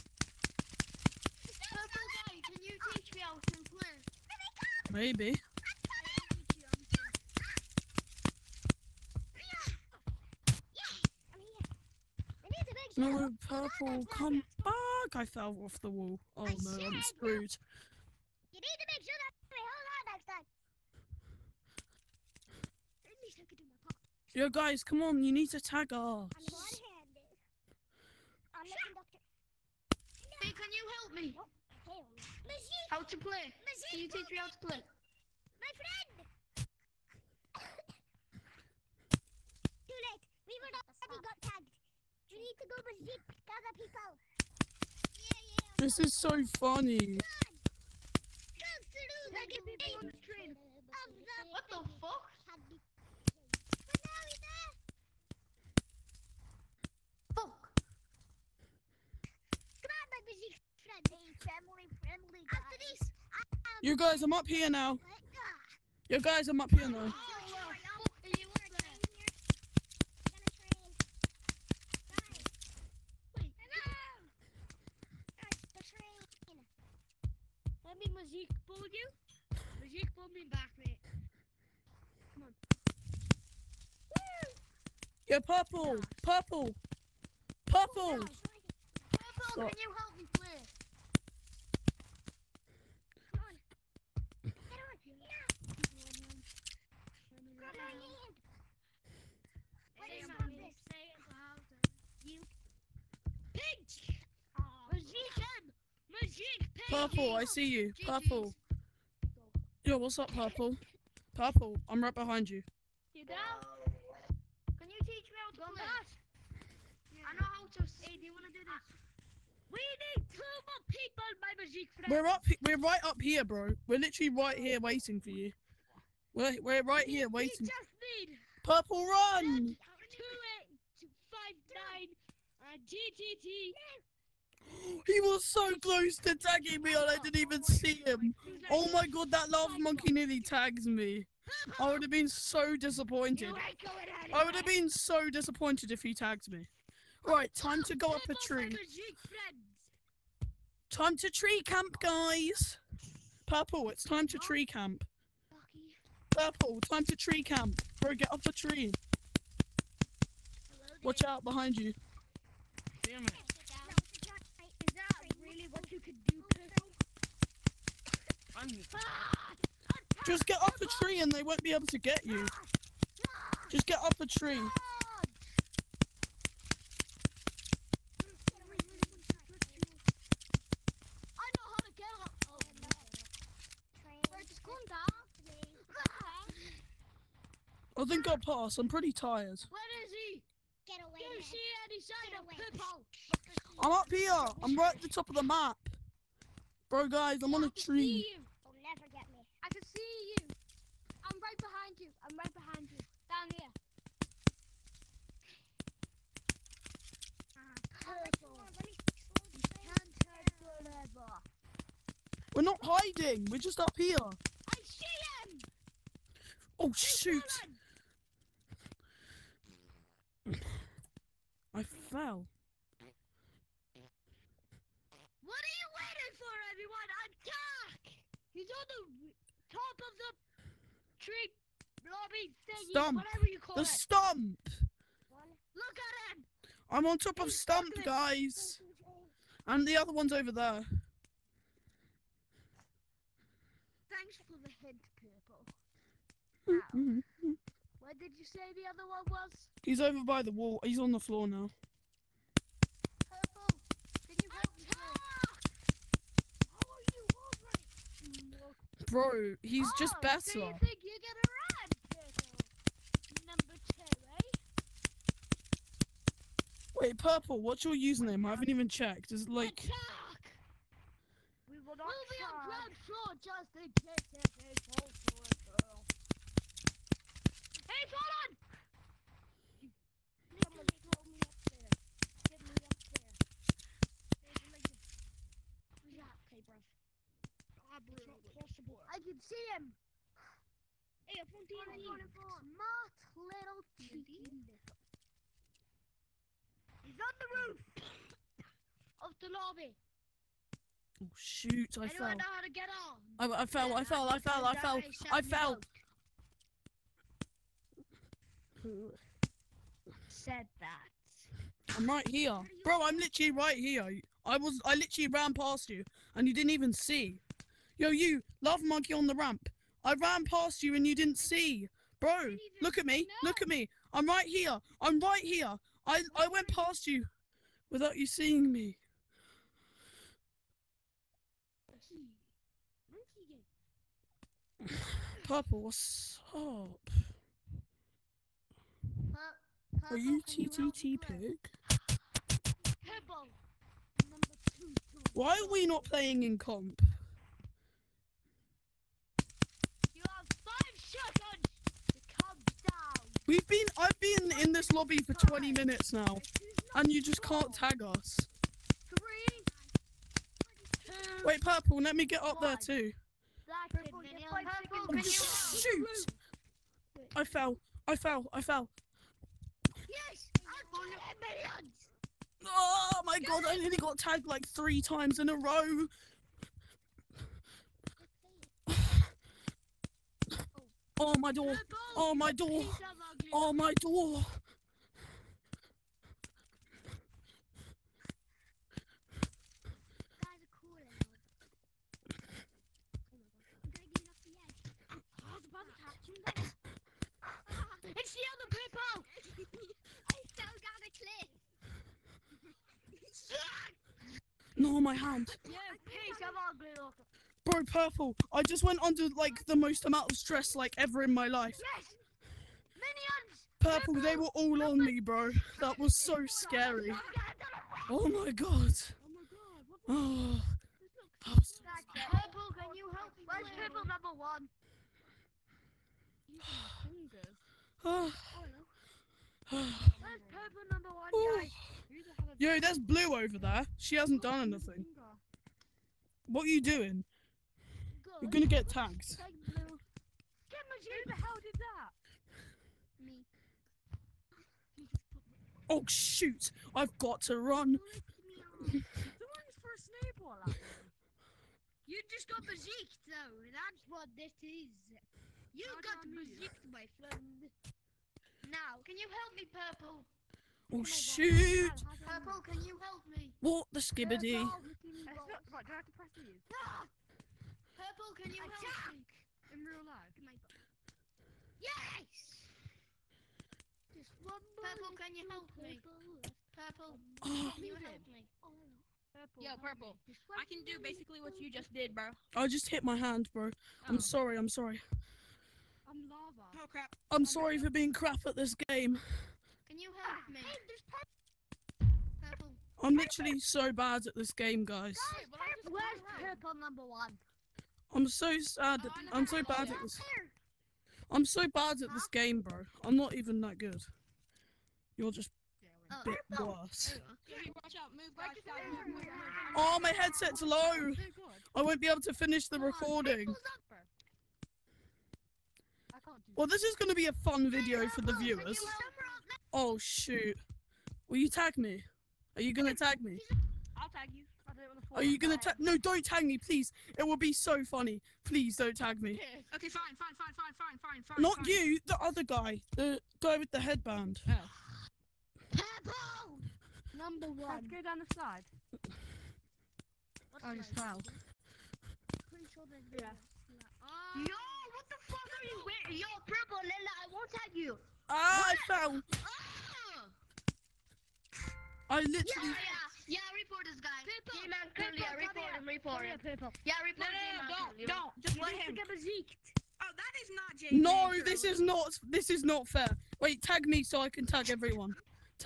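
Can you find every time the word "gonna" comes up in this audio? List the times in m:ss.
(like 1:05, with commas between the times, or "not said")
7:18, 8:45.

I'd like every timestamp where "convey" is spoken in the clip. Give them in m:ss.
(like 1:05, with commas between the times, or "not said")
not said.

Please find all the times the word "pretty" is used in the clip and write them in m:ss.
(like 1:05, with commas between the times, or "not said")
3:08, 9:02.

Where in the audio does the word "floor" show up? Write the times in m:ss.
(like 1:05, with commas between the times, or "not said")
4:11, 4:33.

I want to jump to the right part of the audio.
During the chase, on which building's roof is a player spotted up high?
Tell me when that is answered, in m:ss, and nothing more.
4:59.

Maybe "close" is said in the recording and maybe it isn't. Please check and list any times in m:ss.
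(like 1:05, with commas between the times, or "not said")
2:15.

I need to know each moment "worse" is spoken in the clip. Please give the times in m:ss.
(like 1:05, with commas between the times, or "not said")
8:26.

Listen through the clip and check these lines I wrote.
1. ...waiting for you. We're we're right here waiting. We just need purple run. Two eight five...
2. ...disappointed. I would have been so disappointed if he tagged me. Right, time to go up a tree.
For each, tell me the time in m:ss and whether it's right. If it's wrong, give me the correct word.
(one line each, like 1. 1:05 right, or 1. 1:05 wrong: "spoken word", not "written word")
1. 2:04 right
2. 2:22 right.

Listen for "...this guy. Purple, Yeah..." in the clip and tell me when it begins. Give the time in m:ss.
9:13.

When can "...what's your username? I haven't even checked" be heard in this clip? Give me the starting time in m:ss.
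4:27.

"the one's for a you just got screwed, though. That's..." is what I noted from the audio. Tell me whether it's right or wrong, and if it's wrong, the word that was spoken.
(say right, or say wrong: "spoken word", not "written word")
wrong: "bazooed", not "screwed".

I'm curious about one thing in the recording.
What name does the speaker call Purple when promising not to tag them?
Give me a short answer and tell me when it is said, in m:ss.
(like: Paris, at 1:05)
Lila, at 9:06.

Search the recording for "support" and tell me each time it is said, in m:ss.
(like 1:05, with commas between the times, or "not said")
4:48.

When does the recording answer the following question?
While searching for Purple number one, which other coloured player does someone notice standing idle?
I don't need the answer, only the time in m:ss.
7:12.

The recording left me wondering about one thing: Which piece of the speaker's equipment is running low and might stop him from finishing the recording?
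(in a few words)
Headset.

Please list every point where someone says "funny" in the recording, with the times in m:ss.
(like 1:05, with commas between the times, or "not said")
0:46, 8:47.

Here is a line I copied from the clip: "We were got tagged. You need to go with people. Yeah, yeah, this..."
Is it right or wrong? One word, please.
right.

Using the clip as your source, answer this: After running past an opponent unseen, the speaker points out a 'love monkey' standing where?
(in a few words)
On the ramp.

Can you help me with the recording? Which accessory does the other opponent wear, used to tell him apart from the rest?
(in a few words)
Headband.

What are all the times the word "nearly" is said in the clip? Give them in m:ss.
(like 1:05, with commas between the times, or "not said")
2:20, 6:13.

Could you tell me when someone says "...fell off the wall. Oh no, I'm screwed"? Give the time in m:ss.
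0:15.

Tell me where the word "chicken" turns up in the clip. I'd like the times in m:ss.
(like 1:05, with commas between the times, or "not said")
4:53.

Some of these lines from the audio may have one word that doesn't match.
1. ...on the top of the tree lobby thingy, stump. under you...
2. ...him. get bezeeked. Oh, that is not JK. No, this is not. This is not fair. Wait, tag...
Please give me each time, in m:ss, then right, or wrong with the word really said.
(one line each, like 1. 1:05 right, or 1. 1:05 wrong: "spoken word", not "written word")
1. 3:48 wrong: "whatever", not "under"
2. 9:18 right.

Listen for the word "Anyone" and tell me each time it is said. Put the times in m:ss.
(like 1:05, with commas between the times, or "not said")
5:02.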